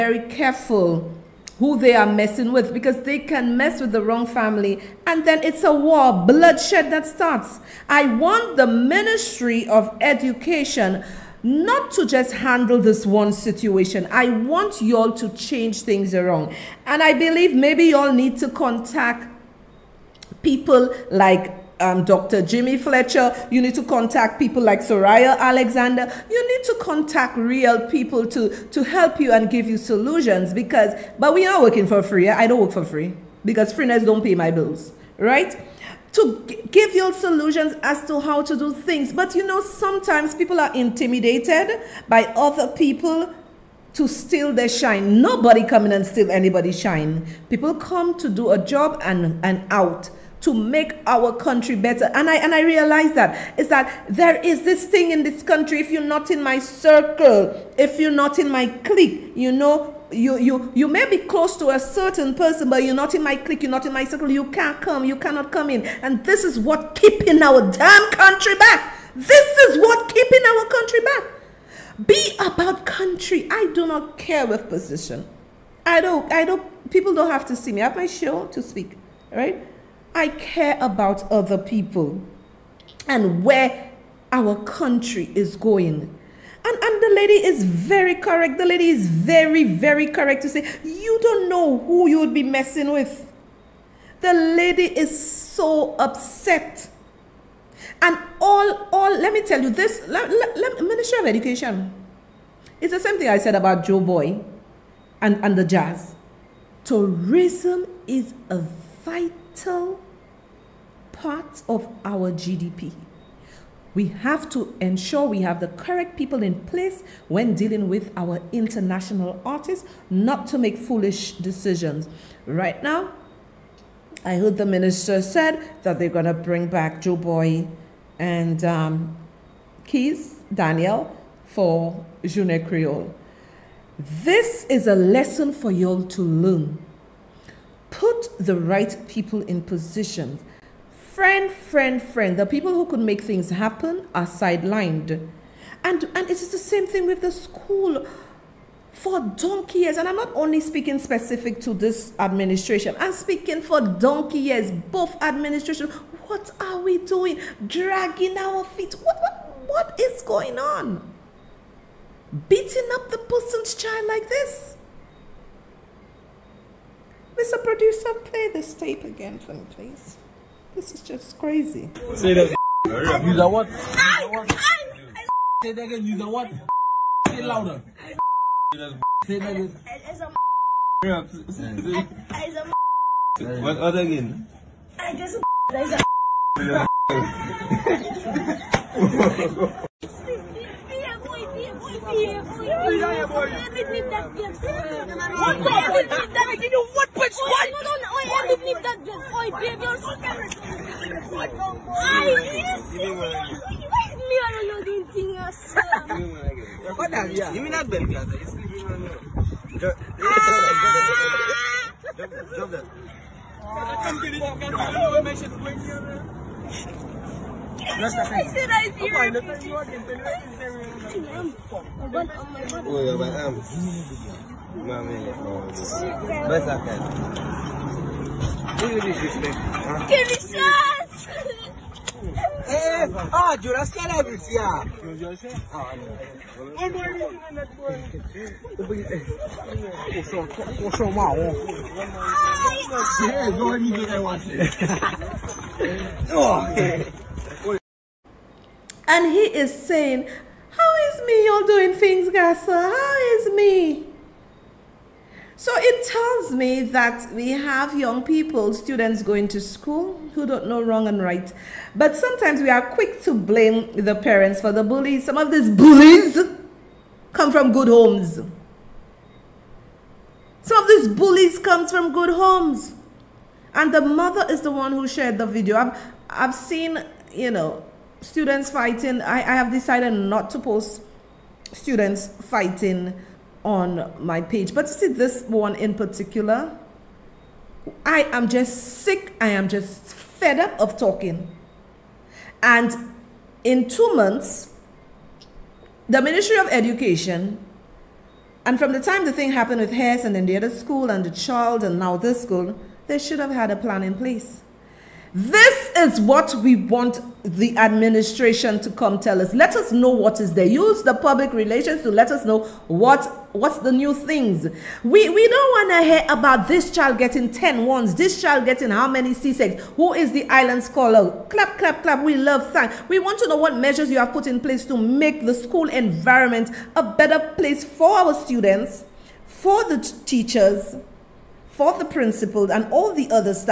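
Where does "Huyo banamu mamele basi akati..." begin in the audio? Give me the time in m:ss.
3:42.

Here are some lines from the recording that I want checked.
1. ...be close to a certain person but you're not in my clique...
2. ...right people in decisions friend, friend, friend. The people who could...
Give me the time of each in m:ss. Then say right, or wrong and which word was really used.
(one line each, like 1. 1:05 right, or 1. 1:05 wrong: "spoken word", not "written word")
1. 1:01 right
2. 2:18 wrong: "positions", not "decisions".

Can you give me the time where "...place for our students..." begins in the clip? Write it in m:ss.
5:27.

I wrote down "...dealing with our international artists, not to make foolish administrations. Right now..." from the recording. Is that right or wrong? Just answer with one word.
wrong.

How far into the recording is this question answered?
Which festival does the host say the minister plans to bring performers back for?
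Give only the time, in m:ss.
2:12.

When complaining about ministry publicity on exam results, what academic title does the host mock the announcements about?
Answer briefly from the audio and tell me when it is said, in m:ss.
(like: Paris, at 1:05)
island scholar, at 5:20.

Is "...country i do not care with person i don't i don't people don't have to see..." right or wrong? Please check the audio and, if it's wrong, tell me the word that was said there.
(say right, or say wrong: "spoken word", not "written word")
wrong: "position", not "person".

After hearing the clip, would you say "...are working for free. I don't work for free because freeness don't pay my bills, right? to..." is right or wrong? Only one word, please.
right.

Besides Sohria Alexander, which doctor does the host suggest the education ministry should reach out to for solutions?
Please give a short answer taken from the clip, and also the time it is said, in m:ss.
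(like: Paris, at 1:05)
Dr. Jimmy Fletcher, at 0:22.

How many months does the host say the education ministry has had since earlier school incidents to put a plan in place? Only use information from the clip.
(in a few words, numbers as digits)
2.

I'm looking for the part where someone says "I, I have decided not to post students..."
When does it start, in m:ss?
4:39.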